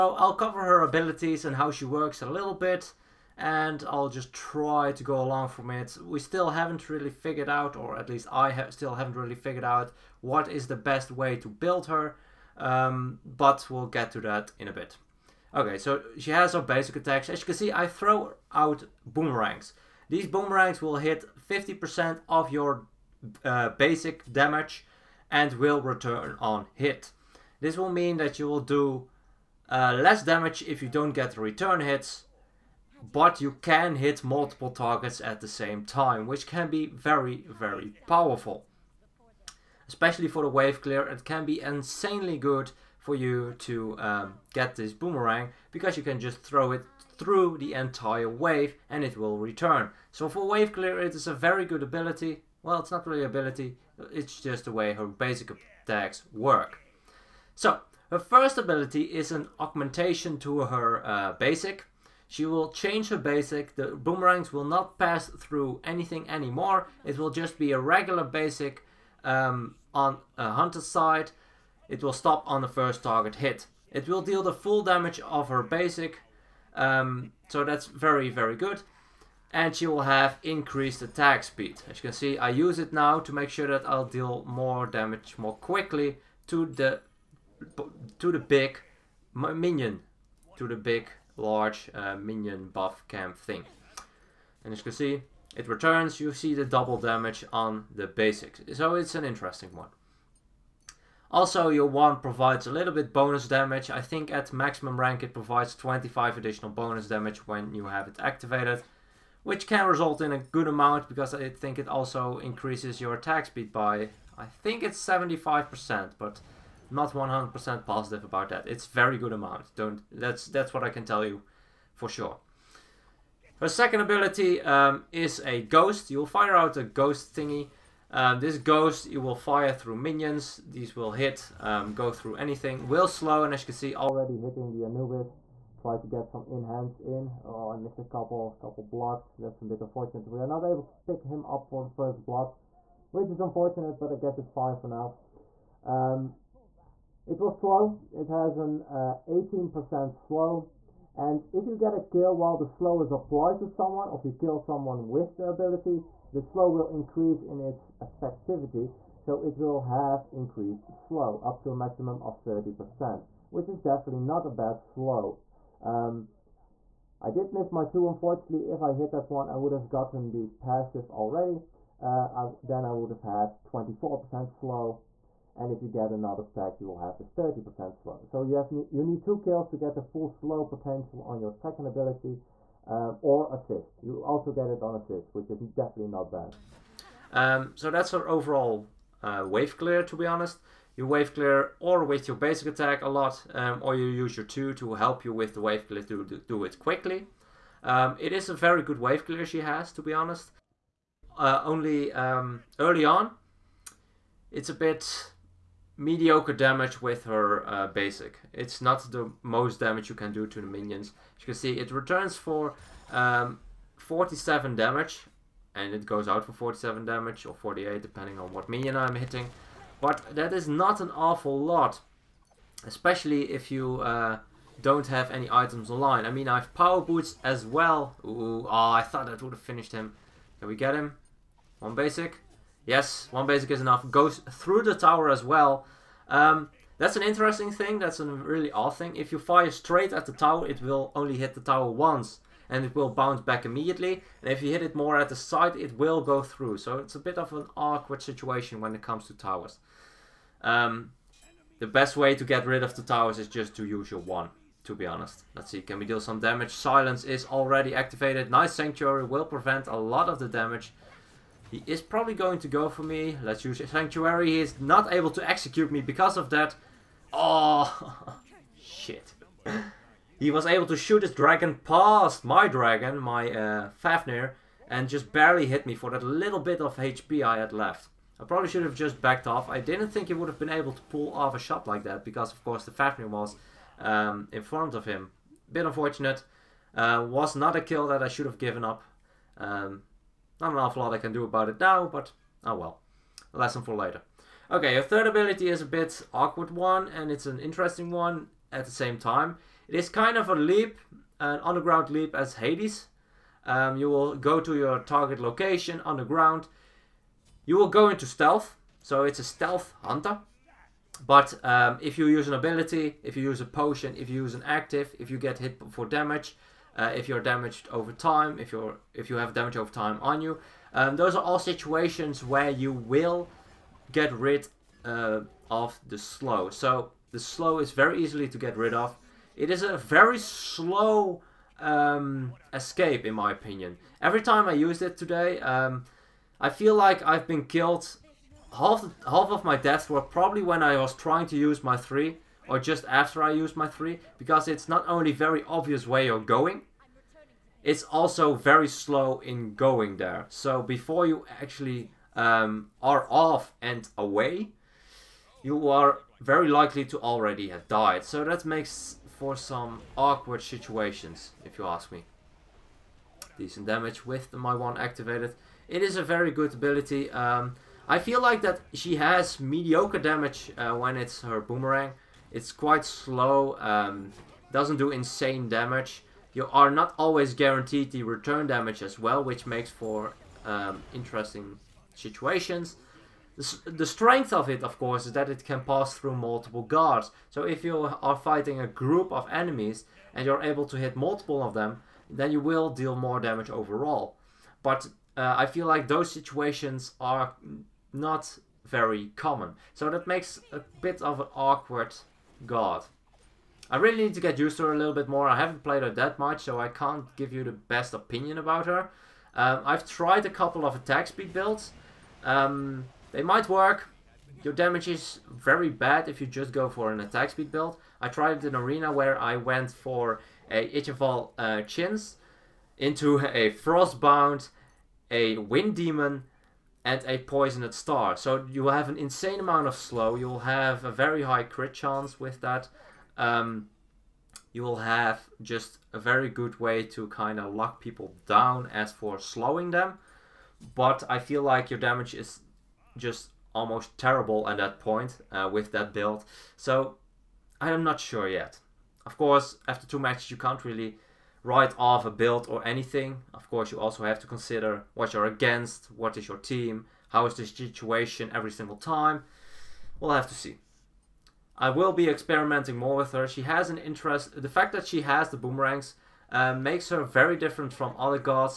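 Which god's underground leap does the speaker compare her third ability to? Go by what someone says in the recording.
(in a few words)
Hades.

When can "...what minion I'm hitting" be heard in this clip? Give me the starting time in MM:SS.
03:38.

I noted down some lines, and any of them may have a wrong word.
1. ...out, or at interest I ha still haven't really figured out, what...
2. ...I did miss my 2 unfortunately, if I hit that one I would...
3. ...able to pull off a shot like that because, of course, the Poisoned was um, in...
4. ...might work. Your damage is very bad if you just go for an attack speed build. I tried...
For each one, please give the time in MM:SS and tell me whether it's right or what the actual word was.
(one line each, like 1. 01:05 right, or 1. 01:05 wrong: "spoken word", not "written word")
1. 00:07 wrong: "least", not "interest"
2. 02:47 right
3. 04:40 wrong: "Fafnir", not "Poisoned"
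4. 06:53 right.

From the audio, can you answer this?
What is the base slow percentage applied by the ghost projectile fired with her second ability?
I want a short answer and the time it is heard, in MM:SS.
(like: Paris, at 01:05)
18%, at 02:28.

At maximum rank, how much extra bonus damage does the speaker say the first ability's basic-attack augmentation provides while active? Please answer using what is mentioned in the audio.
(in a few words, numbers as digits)
25.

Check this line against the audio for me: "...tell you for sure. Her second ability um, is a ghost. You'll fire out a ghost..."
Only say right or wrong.
right.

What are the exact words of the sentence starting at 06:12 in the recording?
It's quite slow, um, doesn't do insane damage.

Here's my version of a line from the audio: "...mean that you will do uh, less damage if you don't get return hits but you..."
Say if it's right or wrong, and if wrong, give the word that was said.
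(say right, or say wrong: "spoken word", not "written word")
right.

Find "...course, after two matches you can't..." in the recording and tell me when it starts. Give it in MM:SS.
07:29.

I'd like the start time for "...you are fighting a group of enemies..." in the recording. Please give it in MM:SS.
06:27.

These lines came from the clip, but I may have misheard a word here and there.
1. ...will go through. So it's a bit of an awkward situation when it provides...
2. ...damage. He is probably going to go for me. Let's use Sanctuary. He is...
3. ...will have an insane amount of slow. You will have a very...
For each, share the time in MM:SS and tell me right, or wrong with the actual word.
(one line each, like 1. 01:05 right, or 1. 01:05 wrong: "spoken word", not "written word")
1. 04:05 wrong: "comes", not "provides"
2. 04:20 right
3. 07:08 right.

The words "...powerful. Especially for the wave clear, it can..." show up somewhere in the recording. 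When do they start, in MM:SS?
00:38.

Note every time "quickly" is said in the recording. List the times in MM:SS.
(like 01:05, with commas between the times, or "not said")
01:25, 03:16.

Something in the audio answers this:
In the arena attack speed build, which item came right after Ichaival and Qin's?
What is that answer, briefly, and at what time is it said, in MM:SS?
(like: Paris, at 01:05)
Frostbound, at 07:03.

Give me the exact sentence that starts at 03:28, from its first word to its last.
It's not the most damage you can do to the minions.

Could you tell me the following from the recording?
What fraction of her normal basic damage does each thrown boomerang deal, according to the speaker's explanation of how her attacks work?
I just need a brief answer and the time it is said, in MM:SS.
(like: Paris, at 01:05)
50%, at 00:21.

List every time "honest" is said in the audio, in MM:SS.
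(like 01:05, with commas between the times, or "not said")
03:10, 03:20, 04:15.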